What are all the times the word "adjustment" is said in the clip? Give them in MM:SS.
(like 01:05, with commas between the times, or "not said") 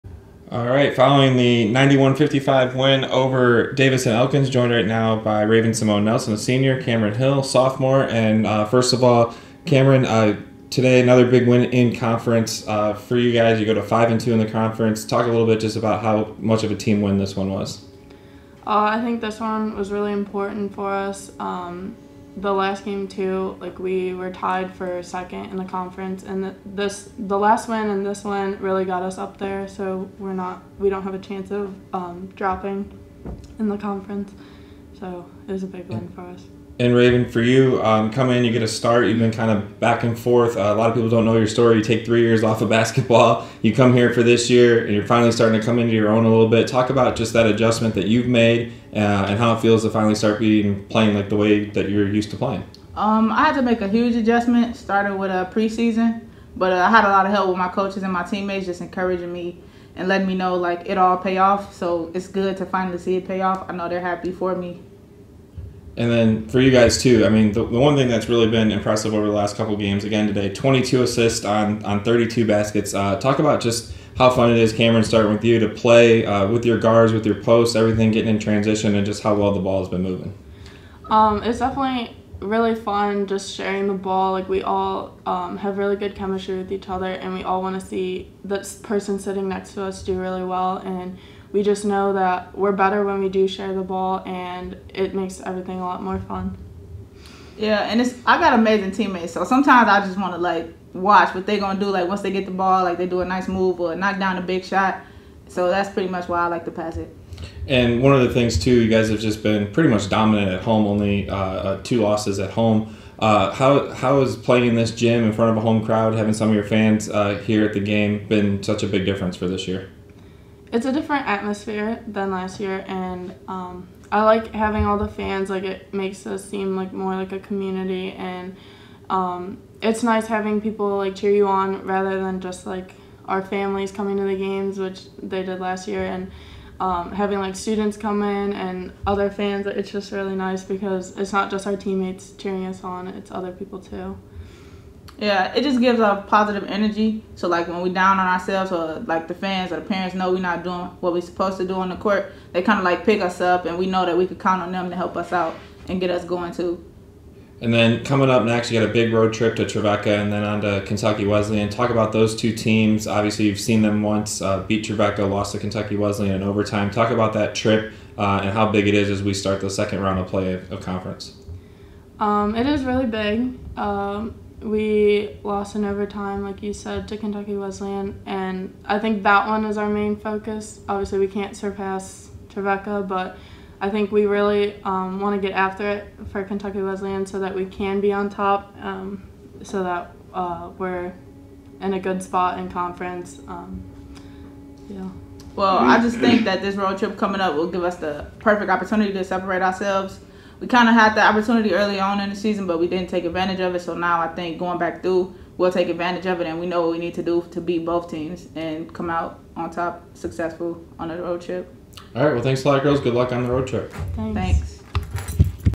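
00:47, 00:54.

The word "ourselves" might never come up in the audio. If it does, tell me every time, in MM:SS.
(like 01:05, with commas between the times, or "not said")
02:28, 03:19.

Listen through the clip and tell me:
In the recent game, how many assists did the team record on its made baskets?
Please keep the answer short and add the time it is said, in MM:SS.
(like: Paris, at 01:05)
22, at 01:10.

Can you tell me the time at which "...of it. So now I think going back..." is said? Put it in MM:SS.
03:23.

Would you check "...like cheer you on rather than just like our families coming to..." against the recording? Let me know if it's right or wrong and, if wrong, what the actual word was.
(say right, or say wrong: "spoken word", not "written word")
right.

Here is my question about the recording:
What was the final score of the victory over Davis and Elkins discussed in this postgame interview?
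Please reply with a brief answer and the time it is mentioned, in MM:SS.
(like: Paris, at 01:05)
91-55, at 00:01.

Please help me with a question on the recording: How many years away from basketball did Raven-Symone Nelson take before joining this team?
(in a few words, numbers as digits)
3.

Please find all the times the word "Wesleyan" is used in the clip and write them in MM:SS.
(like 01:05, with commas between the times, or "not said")
02:41, 02:45, 02:57, 03:06.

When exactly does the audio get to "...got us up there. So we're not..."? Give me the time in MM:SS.
00:28.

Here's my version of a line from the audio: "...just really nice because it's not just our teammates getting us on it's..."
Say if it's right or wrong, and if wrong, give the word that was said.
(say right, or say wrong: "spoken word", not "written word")
wrong: "cheering", not "getting".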